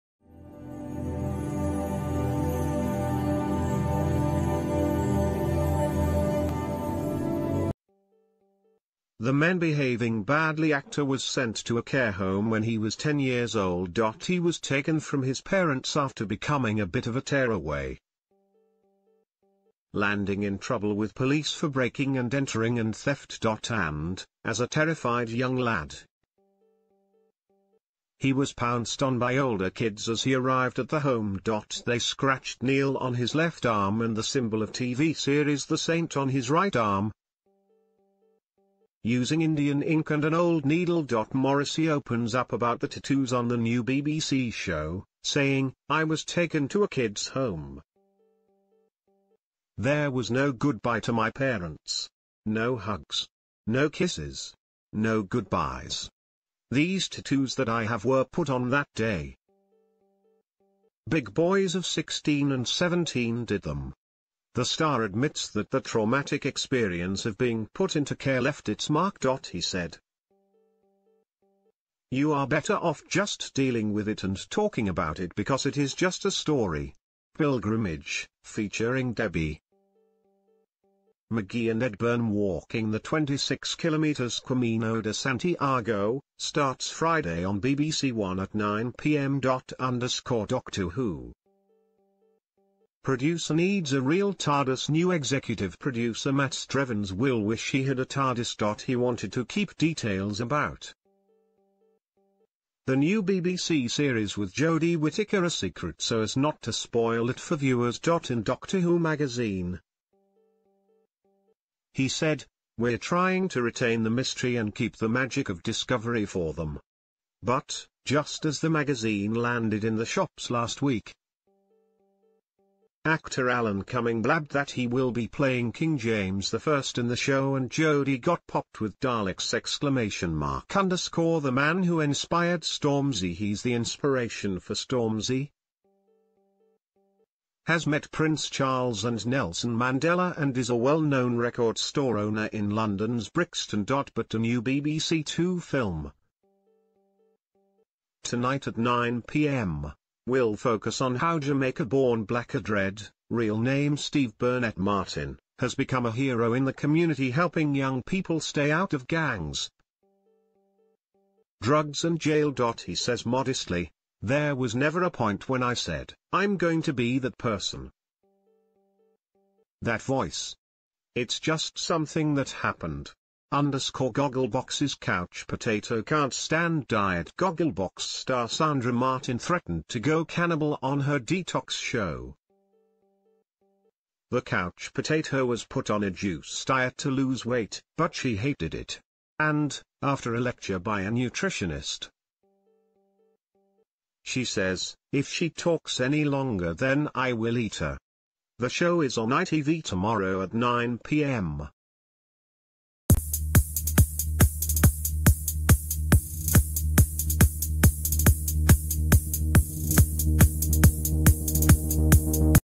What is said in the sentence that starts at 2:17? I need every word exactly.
Has met Prince Charles and Nelson Mandela and is a well-known record store owner in London's Brixton.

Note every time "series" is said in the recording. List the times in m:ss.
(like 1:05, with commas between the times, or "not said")
0:35, 1:43.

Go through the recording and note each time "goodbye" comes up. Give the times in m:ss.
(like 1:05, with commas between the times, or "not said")
0:50, 0:55.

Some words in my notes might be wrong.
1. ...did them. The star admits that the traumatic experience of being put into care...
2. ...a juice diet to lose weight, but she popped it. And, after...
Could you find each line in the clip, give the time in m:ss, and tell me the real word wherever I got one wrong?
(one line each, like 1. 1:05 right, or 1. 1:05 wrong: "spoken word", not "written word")
1. 1:03 right
2. 3:06 wrong: "hated", not "popped".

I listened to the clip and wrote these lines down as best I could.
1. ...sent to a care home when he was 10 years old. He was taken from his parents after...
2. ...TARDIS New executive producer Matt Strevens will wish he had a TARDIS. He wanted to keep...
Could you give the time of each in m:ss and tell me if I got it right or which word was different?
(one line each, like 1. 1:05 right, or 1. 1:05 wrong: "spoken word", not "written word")
1. 0:11 right
2. 1:34 right.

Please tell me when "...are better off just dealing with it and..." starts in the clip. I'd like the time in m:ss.
1:12.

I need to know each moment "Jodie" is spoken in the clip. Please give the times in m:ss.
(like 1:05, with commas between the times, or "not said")
1:44, 2:07.